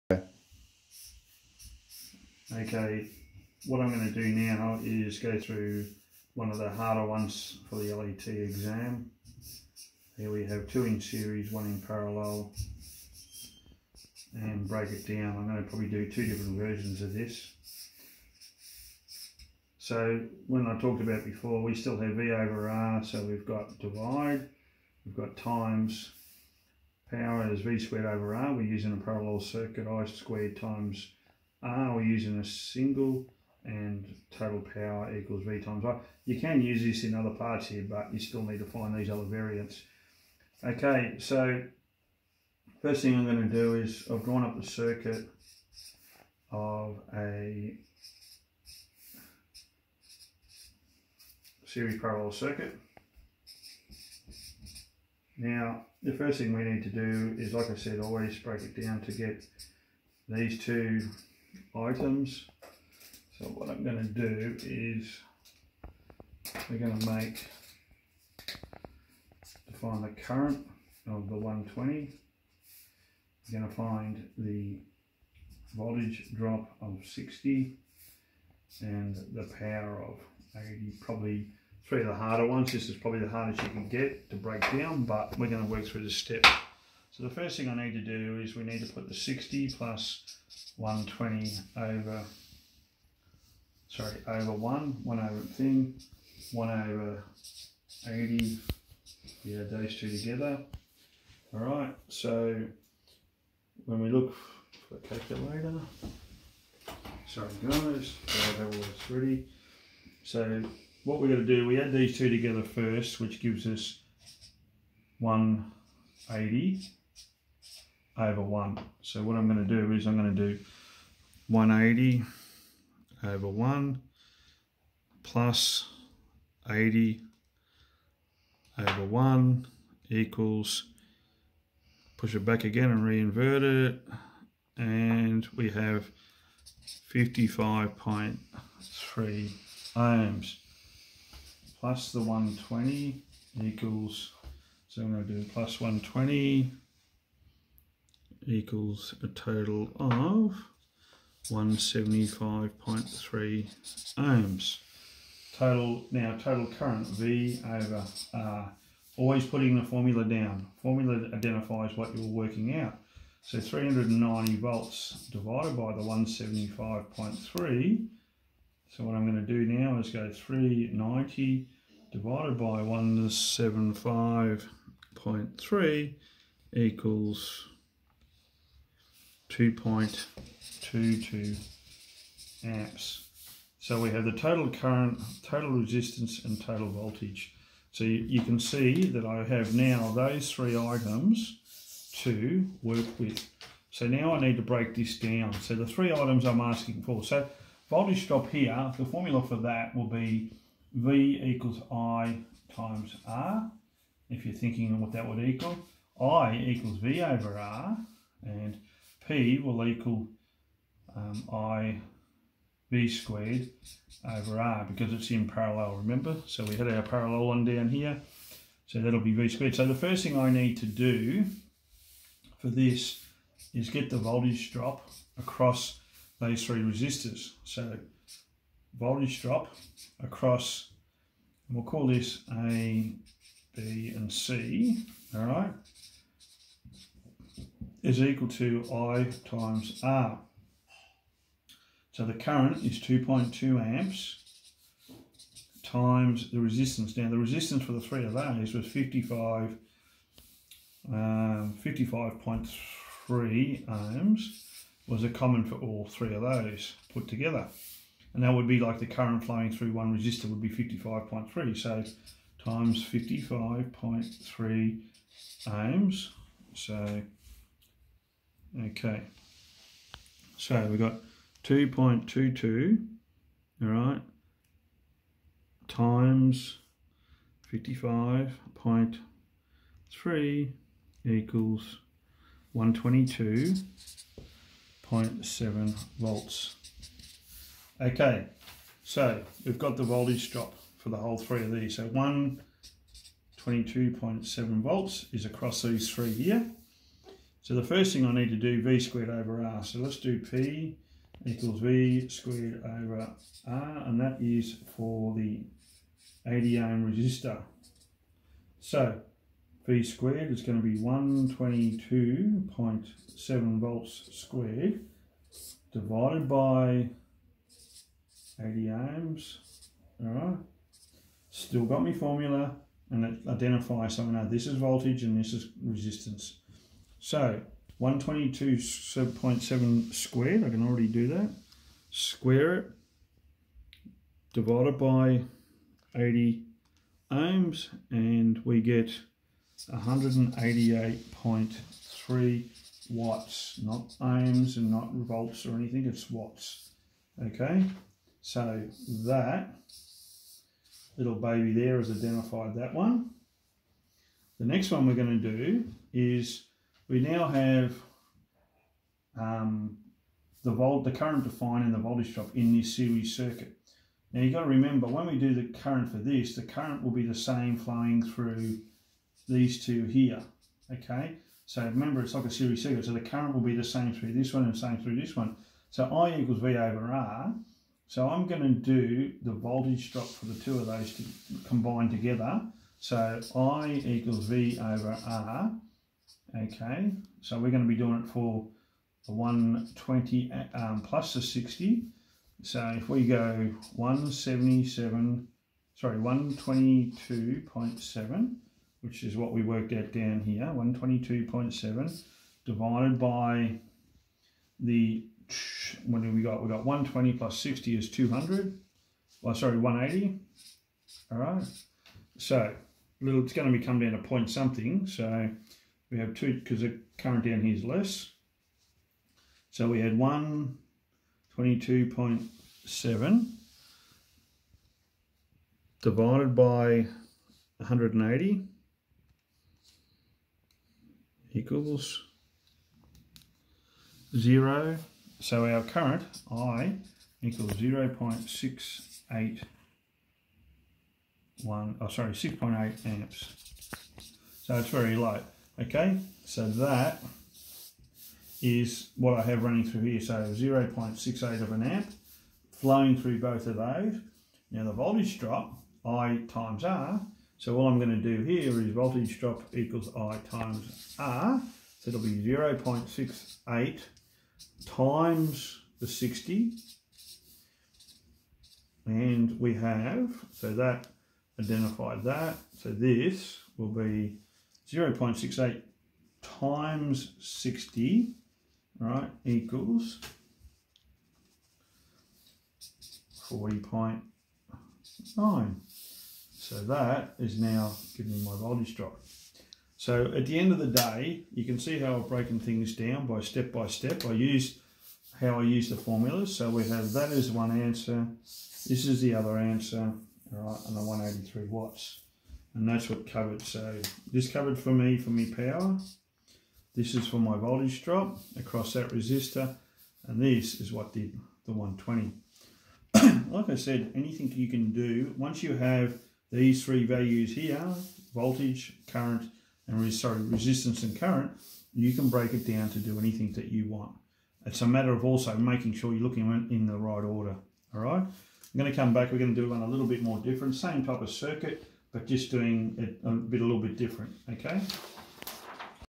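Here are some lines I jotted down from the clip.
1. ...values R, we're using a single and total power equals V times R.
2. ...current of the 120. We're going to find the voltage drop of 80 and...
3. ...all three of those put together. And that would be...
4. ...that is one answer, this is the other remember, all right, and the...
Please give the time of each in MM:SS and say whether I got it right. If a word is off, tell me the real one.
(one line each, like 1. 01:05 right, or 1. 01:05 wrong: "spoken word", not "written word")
1. 00:30 wrong: "times", not "values"
2. 01:10 wrong: "60", not "80"
3. 04:15 right
4. 08:17 wrong: "answer", not "remember".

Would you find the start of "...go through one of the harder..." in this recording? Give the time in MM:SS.
00:05.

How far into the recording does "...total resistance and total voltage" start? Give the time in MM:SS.
03:05.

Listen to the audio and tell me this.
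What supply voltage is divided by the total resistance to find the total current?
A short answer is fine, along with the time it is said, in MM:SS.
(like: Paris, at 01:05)
390 volts, at 02:43.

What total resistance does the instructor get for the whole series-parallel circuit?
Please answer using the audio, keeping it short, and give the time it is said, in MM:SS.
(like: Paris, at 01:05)
175.3 ohms, at 02:31.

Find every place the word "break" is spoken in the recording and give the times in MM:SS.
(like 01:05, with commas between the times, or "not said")
00:14, 00:58, 01:24, 03:14, 08:42.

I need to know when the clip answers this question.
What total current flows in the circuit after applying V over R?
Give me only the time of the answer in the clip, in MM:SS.
02:59.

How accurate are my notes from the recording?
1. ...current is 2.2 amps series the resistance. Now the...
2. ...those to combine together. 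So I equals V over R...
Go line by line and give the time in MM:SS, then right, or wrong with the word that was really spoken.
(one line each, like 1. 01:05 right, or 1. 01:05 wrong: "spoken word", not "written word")
1. 04:02 wrong: "times", not "series"
2. 06:20 right.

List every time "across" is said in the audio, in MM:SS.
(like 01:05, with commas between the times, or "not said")
03:45, 03:50, 04:55, 08:28.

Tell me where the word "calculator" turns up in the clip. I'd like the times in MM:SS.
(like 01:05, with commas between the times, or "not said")
01:45.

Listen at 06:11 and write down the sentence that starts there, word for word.
So remember it's like a series circuit, so the current will be the same through this one and same through this one.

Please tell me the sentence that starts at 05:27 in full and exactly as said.
So 122.7 squared, I can already do that.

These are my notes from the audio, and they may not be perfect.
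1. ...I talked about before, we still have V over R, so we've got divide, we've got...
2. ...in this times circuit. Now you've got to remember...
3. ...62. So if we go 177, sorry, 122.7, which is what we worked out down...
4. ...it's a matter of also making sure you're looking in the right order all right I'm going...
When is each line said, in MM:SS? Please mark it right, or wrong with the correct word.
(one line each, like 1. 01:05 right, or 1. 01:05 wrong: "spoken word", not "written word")
1. 00:20 right
2. 06:02 wrong: "series", not "times"
3. 06:31 wrong: "60", not "62"
4. 08:44 right.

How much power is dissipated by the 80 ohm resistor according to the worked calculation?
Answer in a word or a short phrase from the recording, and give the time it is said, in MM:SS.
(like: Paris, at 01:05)
188.3 watts, at 05:39.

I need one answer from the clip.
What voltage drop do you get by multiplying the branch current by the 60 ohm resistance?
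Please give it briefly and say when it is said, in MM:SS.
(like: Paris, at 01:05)
40.9, at 08:03.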